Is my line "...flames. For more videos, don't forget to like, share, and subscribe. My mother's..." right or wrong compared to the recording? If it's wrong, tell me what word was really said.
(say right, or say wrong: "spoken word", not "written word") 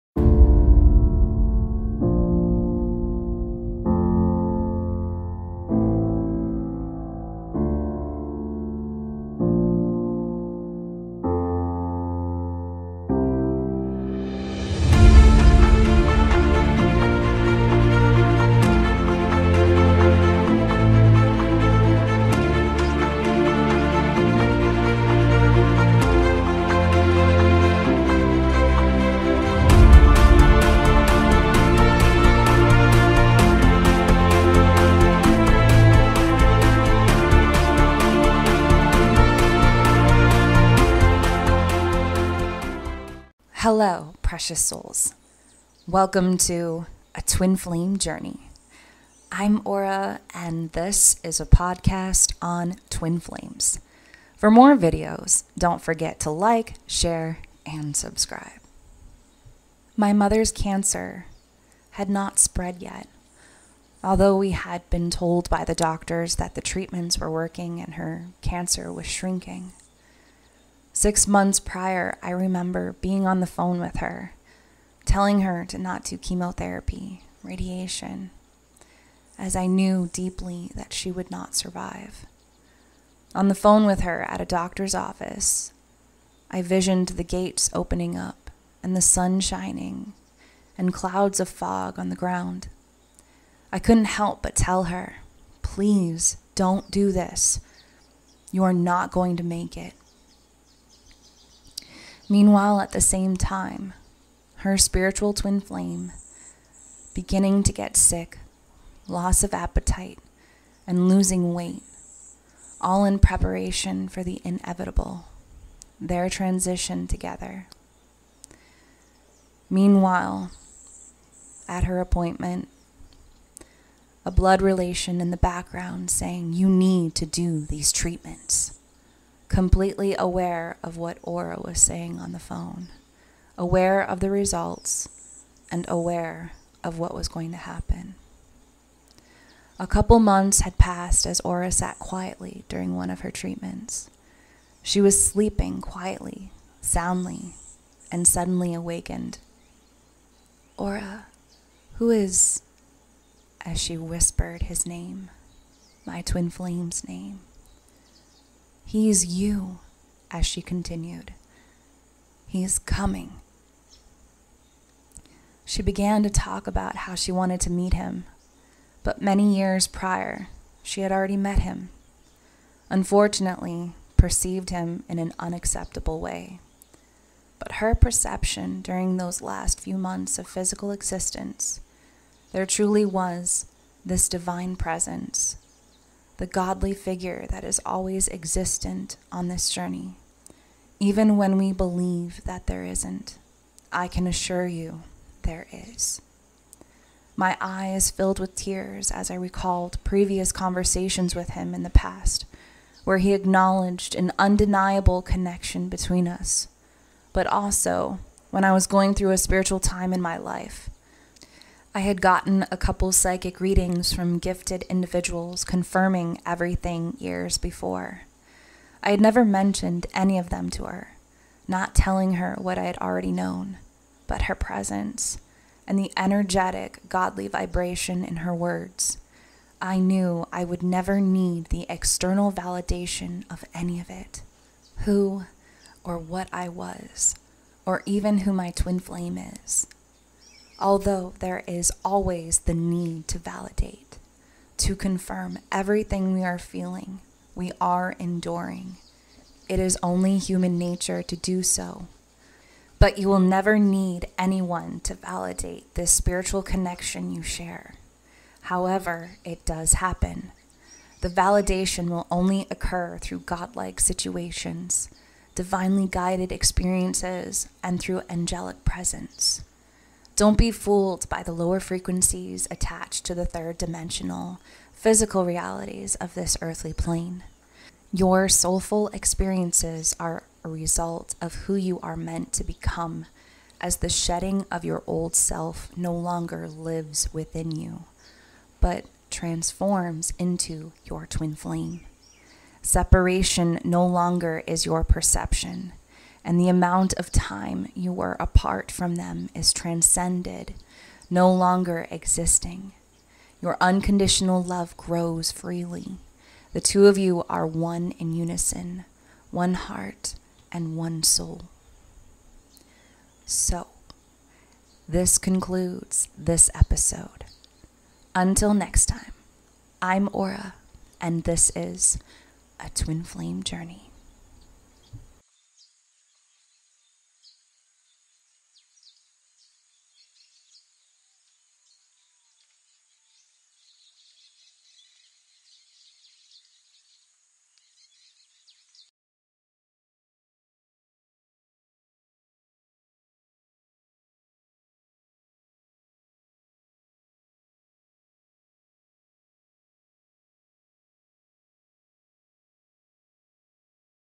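right.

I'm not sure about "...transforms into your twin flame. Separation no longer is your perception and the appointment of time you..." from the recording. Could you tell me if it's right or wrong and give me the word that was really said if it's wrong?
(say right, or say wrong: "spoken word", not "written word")
wrong: "amount", not "appointment".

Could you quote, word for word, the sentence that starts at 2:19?
A couple months had passed as Aura sat quietly during one of her treatments.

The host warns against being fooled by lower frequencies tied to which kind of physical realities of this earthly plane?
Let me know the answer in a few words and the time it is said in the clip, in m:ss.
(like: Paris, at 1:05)
third dimensional, at 4:33.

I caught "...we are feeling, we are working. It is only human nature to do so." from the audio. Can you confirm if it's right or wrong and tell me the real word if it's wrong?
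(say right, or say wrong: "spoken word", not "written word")
wrong: "enduring", not "working".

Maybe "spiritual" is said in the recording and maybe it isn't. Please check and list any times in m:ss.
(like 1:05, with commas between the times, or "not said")
1:44, 3:29, 4:16.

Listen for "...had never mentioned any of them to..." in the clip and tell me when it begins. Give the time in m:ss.
3:39.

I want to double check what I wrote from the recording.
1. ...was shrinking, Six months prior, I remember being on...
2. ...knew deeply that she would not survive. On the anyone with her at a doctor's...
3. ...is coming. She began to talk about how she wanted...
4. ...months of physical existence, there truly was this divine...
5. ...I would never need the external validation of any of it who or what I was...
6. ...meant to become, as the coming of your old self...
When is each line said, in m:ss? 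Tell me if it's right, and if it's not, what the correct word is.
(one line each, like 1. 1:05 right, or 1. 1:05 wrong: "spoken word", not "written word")
1. 1:08 right
2. 1:19 wrong: "phone", not "anyone"
3. 2:42 right
4. 2:59 right
5. 3:50 right
6. 4:42 wrong: "shedding", not "coming".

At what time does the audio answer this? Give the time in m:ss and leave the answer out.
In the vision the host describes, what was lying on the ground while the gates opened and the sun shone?
1:30.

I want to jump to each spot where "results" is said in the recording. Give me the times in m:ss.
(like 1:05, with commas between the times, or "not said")
2:14, 4:40.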